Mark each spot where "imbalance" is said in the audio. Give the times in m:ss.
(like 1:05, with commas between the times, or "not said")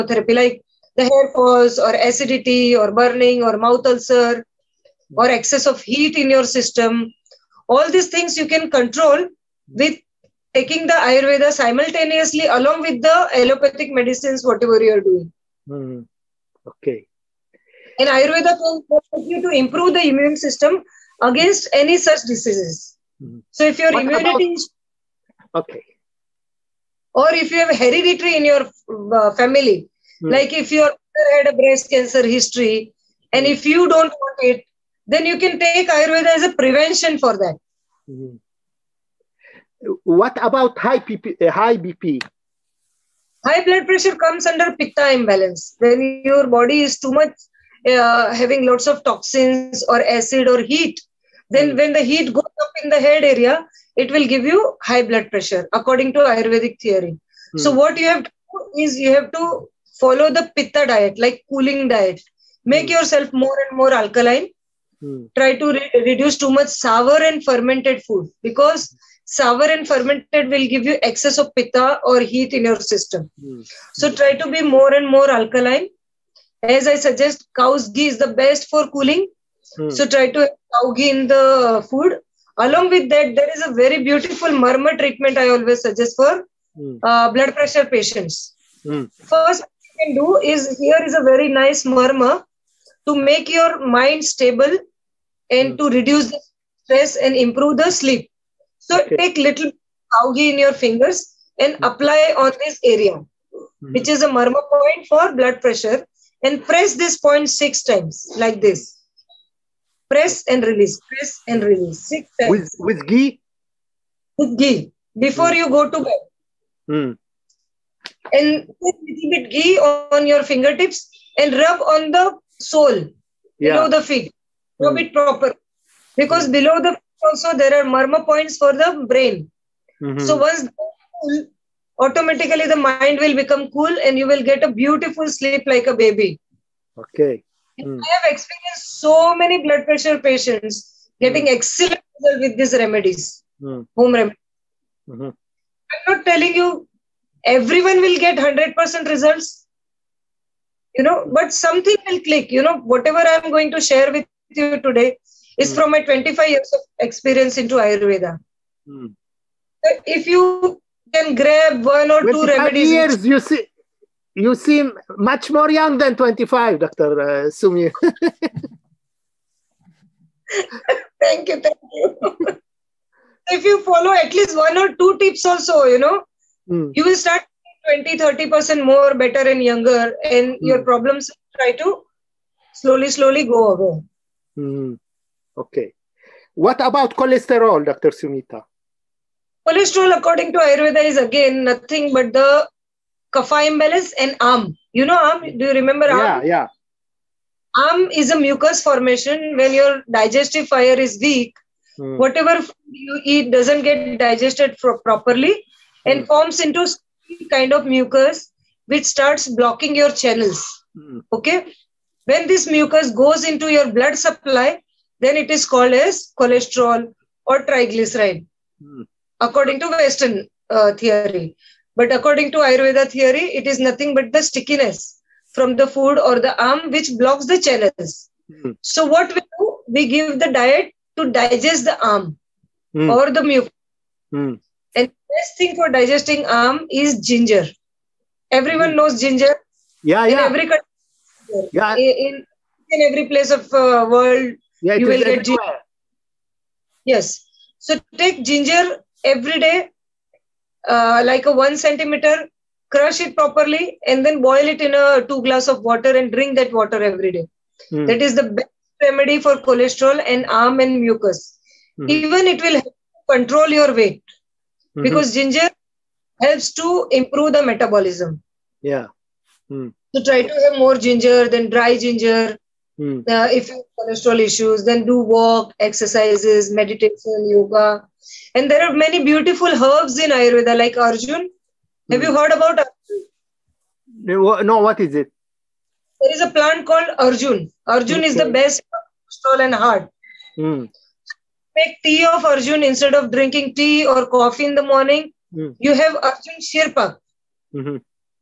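0:45, 3:13.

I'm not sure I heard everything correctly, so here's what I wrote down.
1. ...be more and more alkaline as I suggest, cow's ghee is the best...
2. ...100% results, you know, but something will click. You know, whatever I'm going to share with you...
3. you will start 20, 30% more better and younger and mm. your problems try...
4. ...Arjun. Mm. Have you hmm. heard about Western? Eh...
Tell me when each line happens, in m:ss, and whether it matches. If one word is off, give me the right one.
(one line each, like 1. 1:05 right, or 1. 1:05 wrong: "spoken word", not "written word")
1. 1:14 right
2. 2:28 right
3. 2:56 right
4. 4:40 wrong: "Arjun", not "Western".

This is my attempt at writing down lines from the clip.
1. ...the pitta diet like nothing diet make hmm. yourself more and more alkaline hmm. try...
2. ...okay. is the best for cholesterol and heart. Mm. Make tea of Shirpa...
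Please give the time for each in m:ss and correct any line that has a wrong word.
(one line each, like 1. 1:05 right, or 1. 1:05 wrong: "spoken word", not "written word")
1. 1:00 wrong: "cooling", not "nothing"
2. 4:48 wrong: "Arjun", not "Shirpa".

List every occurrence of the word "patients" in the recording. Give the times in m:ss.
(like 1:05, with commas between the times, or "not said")
1:27, 2:20.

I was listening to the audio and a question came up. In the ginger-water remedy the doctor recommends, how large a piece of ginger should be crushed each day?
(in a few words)
1 centimeter.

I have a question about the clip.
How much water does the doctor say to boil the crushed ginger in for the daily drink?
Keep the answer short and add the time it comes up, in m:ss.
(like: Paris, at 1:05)
2 glasses, at 4:15.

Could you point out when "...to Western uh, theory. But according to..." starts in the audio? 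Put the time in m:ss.
3:39.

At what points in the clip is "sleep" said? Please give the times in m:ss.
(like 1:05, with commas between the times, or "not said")
1:37, 2:15.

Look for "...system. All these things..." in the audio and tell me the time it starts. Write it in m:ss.
0:06.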